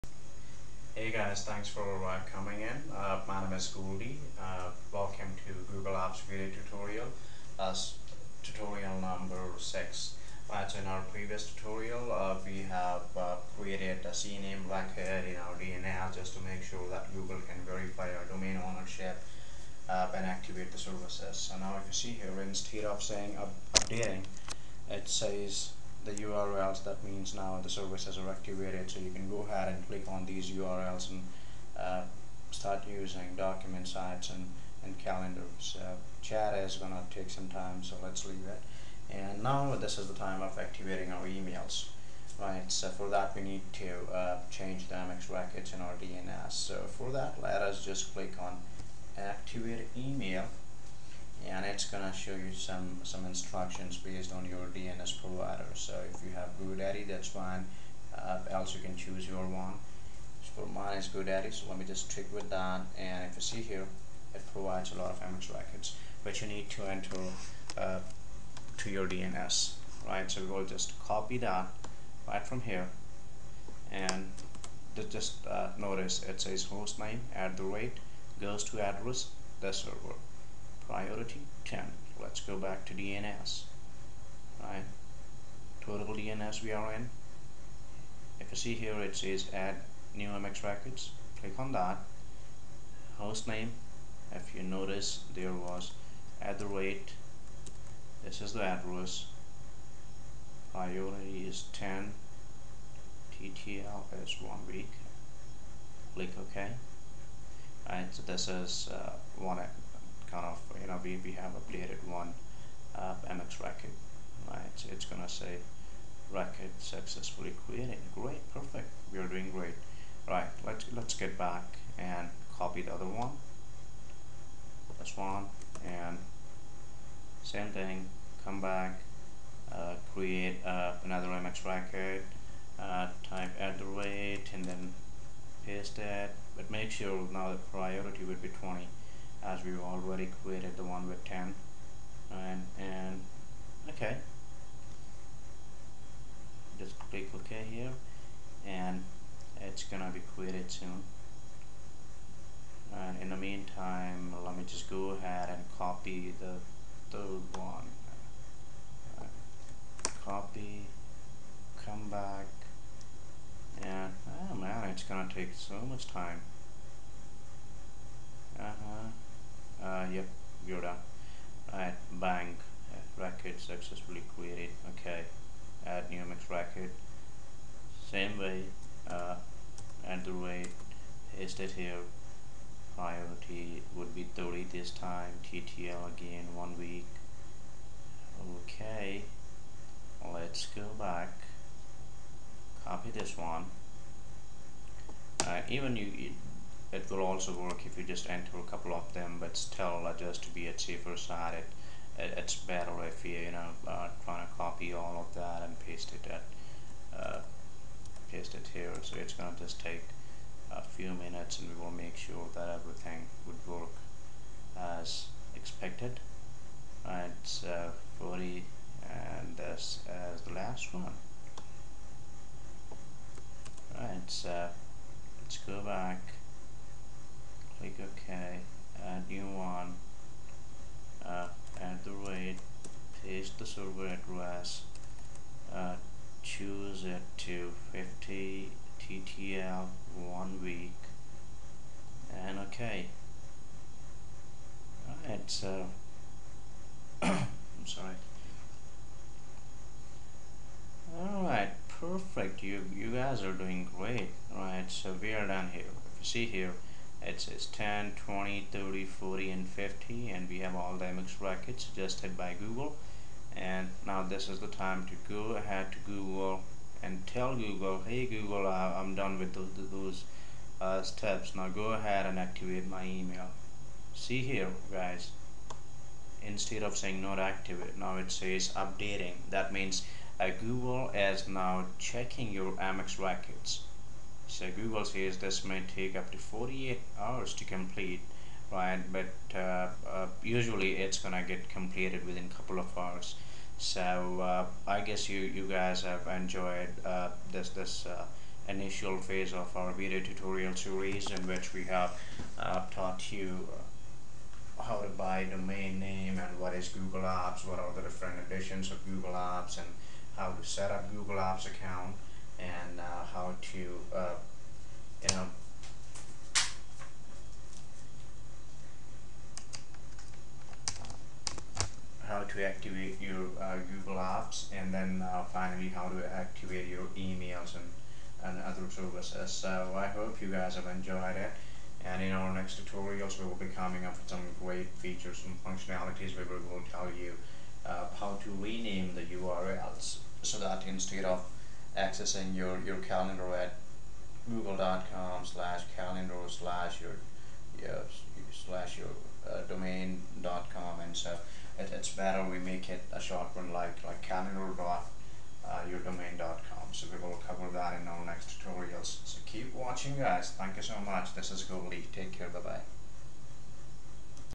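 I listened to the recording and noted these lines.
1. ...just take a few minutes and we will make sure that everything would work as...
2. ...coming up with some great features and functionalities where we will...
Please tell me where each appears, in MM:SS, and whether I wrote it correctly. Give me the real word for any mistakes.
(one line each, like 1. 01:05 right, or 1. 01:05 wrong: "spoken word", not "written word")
1. 03:29 right
2. 05:33 right.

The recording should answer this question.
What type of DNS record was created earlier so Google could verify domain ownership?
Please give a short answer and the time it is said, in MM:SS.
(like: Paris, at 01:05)
CNAME, at 00:14.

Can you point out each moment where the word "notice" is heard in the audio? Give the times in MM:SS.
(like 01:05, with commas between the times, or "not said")
01:15, 01:34.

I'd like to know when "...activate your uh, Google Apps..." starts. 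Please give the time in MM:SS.
05:22.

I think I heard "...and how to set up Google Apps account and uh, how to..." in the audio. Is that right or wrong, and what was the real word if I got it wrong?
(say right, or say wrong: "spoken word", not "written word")
right.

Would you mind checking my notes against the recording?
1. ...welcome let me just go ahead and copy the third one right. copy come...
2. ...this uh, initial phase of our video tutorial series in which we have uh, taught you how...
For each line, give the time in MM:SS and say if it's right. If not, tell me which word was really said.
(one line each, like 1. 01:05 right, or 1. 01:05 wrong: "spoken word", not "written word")
1. 02:33 wrong: "meantime", not "welcome"
2. 04:57 right.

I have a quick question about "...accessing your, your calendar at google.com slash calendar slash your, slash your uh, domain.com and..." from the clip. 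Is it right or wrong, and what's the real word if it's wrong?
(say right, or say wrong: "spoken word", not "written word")
right.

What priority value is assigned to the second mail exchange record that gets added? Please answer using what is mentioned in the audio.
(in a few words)
20.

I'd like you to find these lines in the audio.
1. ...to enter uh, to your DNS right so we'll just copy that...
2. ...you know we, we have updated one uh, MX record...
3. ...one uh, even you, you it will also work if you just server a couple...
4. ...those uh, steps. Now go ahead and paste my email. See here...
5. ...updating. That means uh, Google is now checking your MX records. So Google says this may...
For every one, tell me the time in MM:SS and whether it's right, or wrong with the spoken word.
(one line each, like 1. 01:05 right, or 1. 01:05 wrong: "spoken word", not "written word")
1. 01:06 right
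2. 01:50 right
3. 03:13 wrong: "enter", not "server"
4. 04:29 wrong: "activate", not "paste"
5. 04:38 right.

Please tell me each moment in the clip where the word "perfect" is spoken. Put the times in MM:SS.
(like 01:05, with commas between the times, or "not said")
01:58, 04:11.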